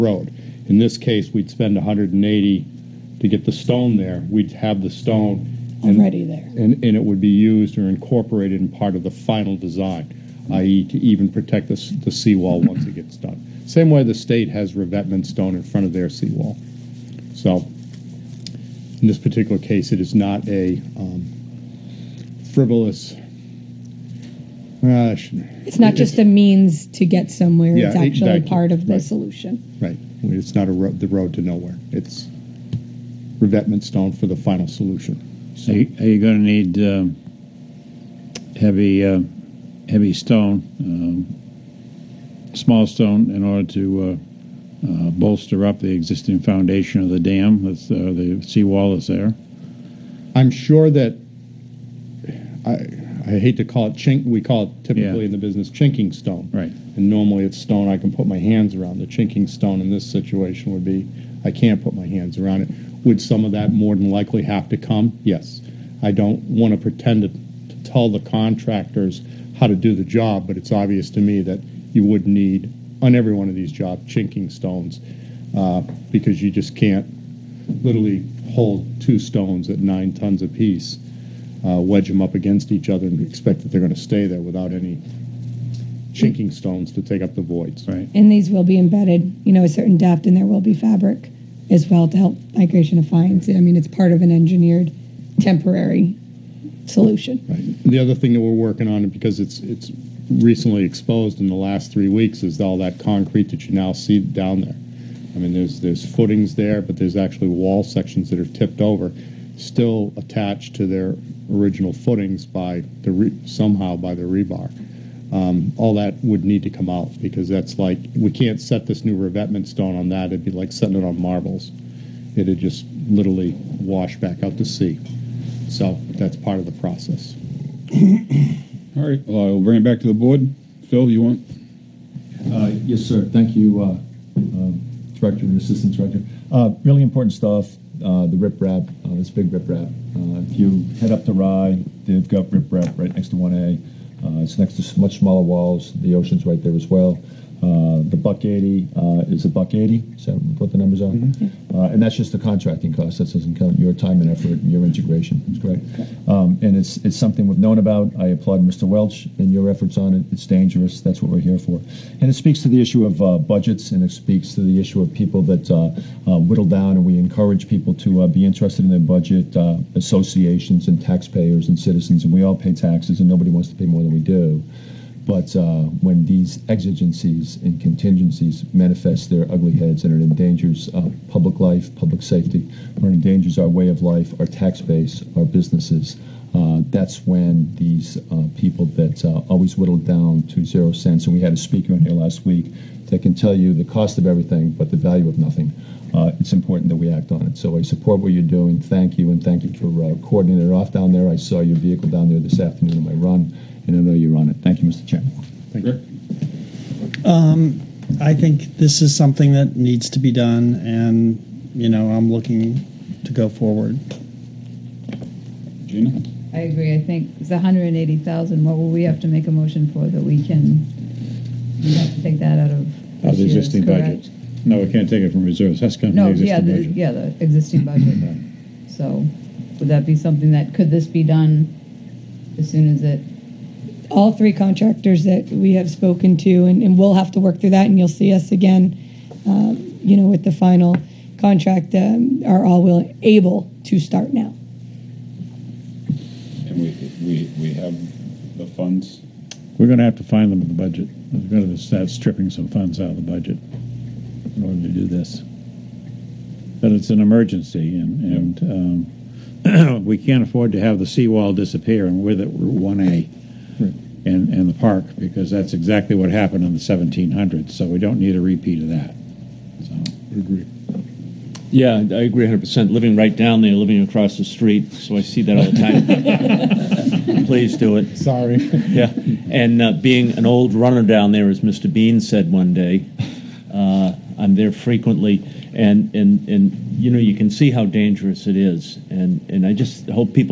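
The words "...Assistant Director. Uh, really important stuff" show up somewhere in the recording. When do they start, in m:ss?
2:15.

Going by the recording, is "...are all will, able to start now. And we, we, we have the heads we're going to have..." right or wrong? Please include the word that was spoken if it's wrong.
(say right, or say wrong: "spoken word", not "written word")
wrong: "funds", not "heads".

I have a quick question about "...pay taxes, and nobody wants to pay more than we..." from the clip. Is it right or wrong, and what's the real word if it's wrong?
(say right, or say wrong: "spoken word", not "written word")
right.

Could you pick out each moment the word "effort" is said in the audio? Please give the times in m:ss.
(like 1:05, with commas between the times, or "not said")
2:34, 2:39.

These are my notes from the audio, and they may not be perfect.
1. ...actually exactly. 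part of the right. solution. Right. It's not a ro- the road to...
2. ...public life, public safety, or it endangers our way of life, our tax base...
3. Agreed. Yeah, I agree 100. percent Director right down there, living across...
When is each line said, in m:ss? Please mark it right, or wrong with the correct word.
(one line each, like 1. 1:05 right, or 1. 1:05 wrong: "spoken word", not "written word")
1. 0:27 right
2. 3:01 right
3. 4:30 wrong: "Living", not "Director".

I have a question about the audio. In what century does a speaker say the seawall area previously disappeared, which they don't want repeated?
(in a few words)
1700s.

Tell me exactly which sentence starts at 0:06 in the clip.
And, and it would be used or incorporated in part of the final design, i.e.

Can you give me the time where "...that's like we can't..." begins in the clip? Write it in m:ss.
1:57.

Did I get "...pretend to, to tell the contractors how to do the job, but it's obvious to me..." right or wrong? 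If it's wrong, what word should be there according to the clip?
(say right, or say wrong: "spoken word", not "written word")
right.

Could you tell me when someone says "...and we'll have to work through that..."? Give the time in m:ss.
3:56.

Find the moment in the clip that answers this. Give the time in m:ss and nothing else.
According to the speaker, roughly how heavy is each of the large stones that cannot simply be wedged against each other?
1:19.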